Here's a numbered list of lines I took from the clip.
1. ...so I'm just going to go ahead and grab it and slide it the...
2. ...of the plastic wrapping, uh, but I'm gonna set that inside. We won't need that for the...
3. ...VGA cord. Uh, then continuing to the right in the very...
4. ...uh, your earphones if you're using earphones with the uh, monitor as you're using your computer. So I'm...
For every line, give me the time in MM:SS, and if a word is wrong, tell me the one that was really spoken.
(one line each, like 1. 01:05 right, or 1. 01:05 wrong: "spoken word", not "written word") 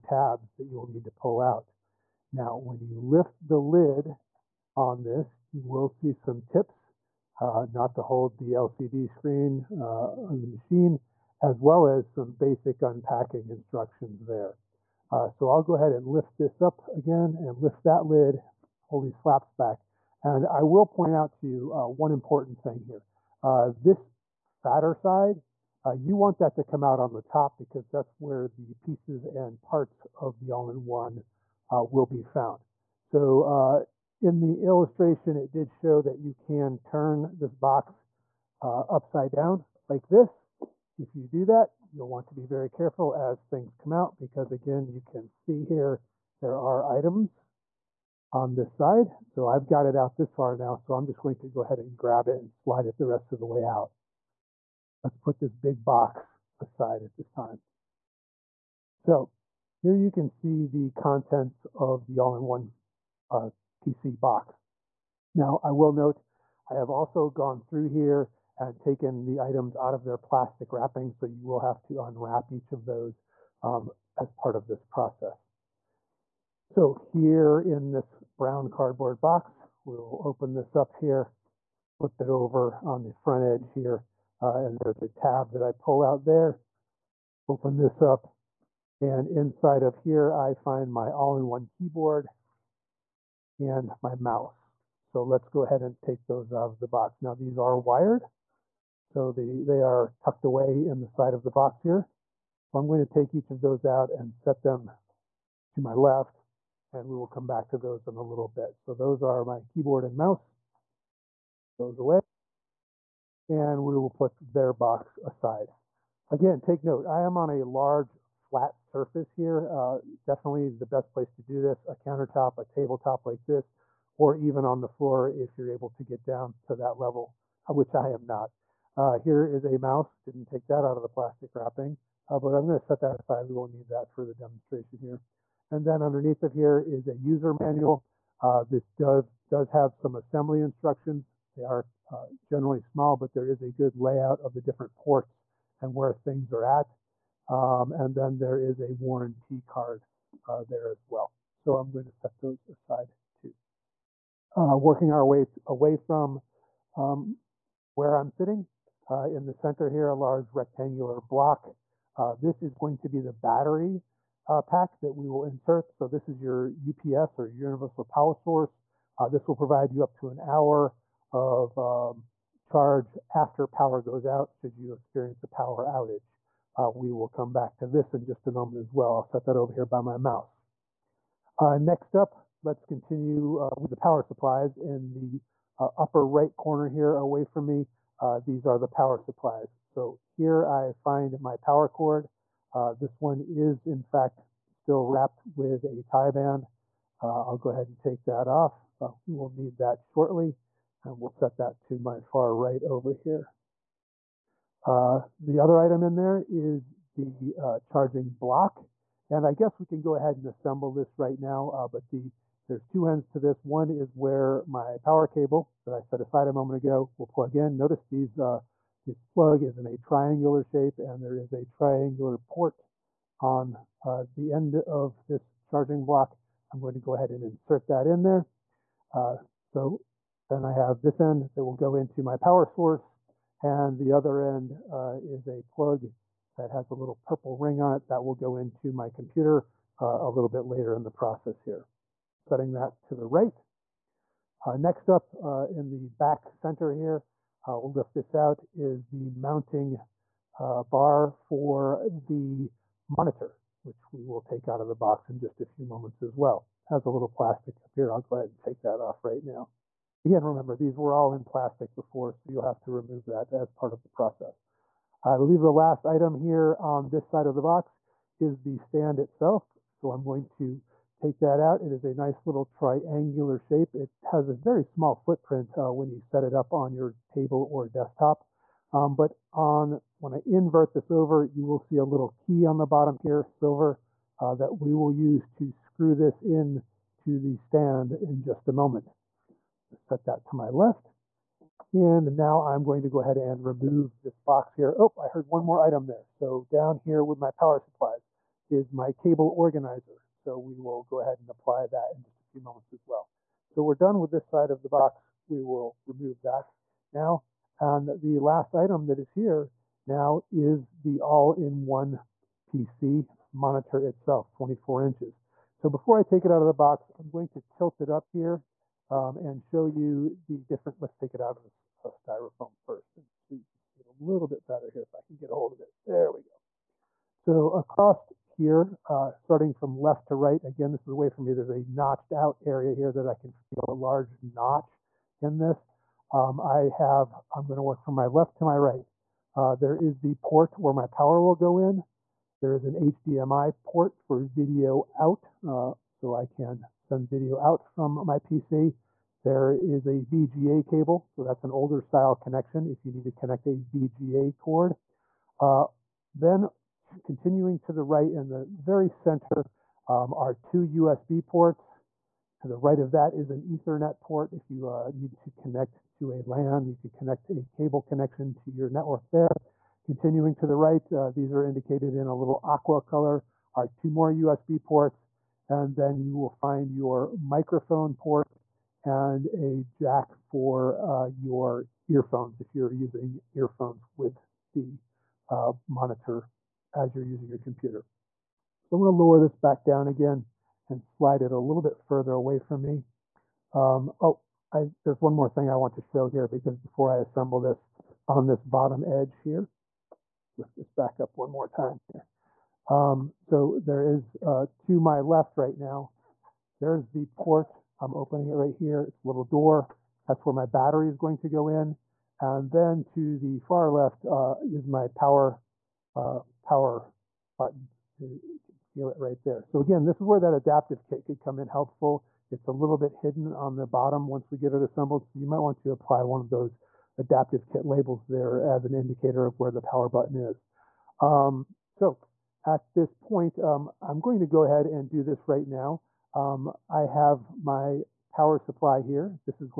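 1. 00:50 right
2. 02:10 wrong: "aside", not "inside"
3. 05:53 right
4. 06:21 right.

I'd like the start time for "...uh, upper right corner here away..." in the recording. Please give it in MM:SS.
03:05.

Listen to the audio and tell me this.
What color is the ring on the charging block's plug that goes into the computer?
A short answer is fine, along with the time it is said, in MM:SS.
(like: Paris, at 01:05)
purple, at 03:57.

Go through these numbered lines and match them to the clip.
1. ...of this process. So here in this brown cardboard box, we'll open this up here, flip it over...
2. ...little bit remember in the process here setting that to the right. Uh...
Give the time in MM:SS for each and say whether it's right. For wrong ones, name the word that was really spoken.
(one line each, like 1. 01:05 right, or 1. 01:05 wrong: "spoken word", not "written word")
1. 01:14 right
2. 04:00 wrong: "later", not "remember".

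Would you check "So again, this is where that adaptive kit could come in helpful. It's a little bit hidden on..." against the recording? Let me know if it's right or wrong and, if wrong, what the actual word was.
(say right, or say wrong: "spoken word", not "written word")
right.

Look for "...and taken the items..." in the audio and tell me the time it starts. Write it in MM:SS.
01:08.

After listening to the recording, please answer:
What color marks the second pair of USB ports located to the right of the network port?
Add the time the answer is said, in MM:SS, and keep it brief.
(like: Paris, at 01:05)
aqua, at 06:12.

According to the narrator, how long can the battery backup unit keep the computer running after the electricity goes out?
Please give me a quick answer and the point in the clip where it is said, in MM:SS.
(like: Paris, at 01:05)
up to an hour, at 02:50.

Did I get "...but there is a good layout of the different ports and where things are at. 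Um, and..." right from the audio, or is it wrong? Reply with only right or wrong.
right.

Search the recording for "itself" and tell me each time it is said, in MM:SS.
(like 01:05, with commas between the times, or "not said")
04:29, 05:14.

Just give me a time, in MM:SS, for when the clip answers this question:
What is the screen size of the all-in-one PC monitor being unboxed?
05:14.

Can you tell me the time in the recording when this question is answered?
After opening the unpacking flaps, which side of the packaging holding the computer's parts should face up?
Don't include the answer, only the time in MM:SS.
00:24.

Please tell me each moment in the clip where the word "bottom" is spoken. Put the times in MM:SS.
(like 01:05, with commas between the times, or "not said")
04:42, 06:38, 07:03.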